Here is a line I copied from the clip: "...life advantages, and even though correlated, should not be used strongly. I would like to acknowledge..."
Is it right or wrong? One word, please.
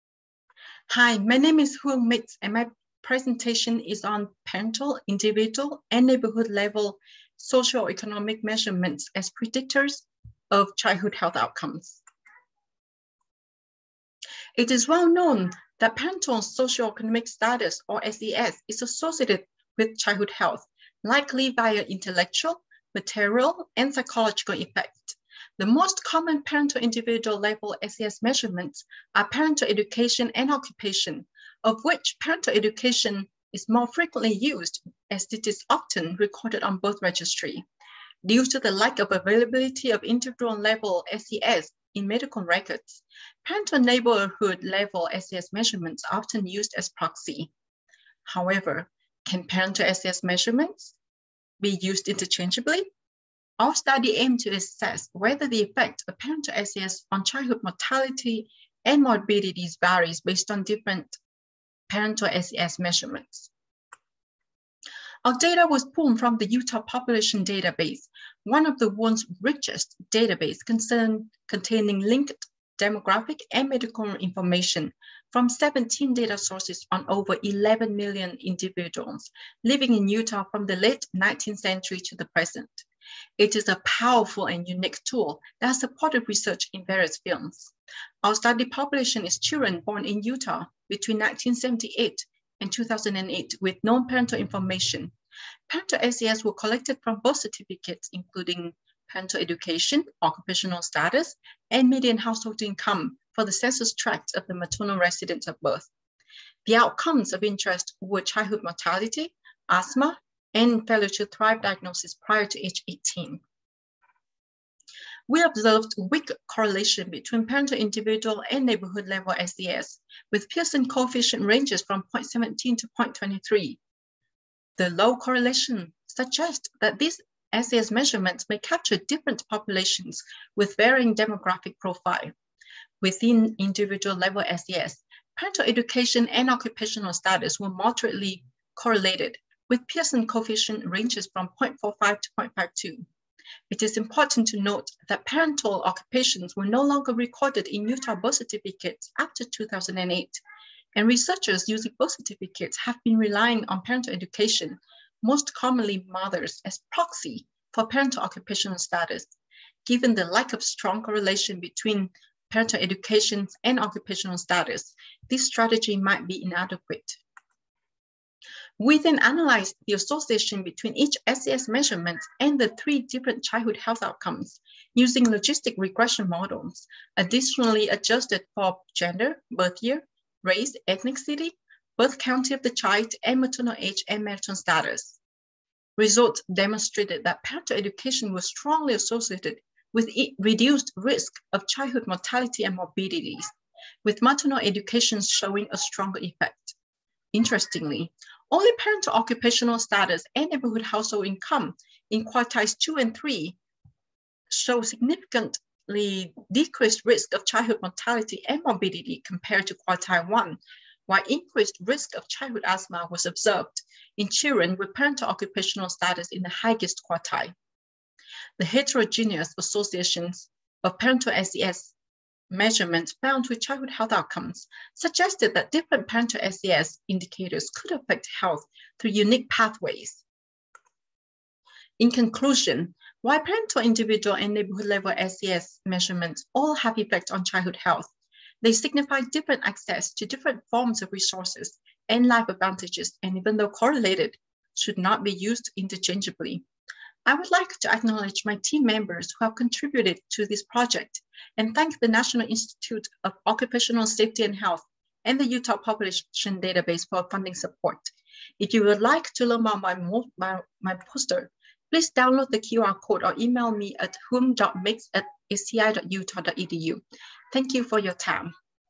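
wrong.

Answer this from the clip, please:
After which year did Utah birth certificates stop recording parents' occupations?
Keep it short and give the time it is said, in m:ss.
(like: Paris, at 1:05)
2008, at 2:29.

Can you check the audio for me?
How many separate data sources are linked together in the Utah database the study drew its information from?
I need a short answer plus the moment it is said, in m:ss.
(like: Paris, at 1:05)
17, at 1:15.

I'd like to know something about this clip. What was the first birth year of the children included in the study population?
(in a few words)
1978.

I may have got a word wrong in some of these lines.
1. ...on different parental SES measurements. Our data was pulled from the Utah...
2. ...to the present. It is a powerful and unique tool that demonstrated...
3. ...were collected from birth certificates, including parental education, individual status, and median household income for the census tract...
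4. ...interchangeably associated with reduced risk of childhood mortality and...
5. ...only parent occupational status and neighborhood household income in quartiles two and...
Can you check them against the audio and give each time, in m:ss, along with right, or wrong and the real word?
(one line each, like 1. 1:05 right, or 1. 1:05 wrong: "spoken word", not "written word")
1. 1:00 right
2. 1:22 wrong: "supported", not "demonstrated"
3. 1:36 wrong: "occupational", not "individual"
4. 3:08 wrong: "strongly", not "interchangeably"
5. 3:18 right.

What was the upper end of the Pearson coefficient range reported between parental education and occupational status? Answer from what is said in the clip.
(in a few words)
0.52.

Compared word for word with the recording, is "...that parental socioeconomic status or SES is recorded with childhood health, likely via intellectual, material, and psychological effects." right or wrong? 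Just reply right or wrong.
wrong.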